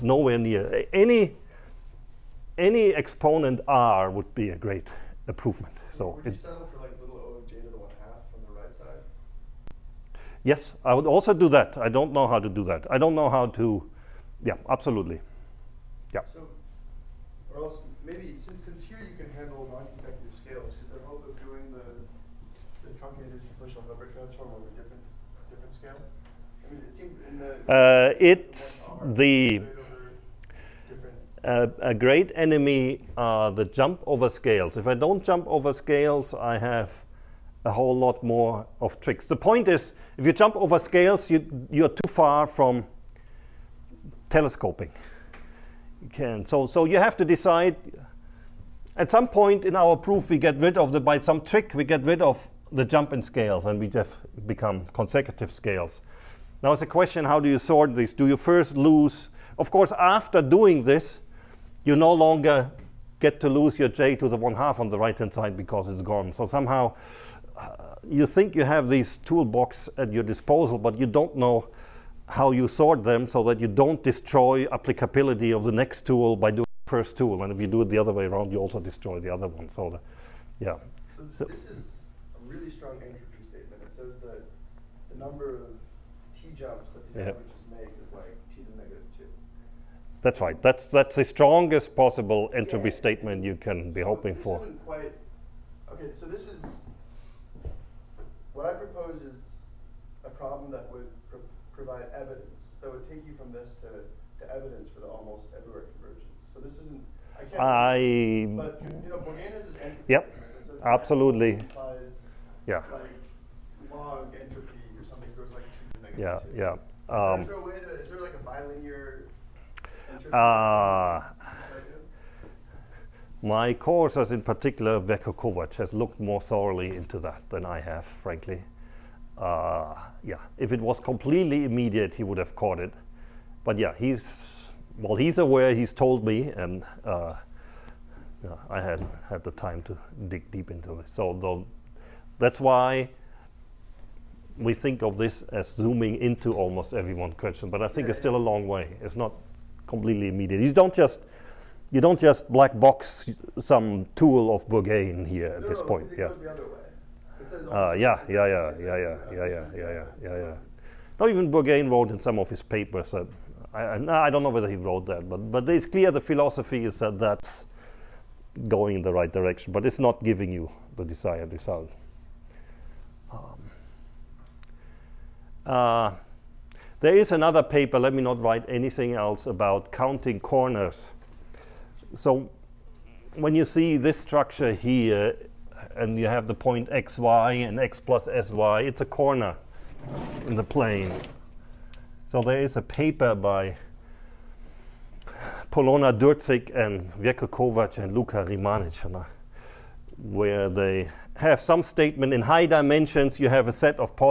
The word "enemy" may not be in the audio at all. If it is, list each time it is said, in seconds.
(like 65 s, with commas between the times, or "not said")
32 s.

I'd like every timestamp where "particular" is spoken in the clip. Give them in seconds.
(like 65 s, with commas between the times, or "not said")
124 s.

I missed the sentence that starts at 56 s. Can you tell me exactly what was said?
Now it's a question, how do you sort this?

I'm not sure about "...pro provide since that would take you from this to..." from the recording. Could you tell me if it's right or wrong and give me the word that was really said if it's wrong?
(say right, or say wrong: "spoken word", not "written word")
wrong: "evidence", not "since".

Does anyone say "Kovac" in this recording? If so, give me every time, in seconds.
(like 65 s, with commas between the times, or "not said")
125 s, 197 s.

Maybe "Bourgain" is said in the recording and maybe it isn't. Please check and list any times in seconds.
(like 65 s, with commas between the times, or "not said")
109 s, 154 s, 161 s.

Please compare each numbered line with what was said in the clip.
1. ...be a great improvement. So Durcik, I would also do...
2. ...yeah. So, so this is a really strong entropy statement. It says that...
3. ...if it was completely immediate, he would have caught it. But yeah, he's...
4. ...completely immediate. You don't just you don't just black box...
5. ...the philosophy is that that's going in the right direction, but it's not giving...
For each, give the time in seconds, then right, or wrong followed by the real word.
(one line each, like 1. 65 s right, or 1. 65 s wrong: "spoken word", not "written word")
1. 4 s wrong: "Yes", not "Durcik"
2. 80 s right
3. 130 s right
4. 149 s right
5. 166 s right.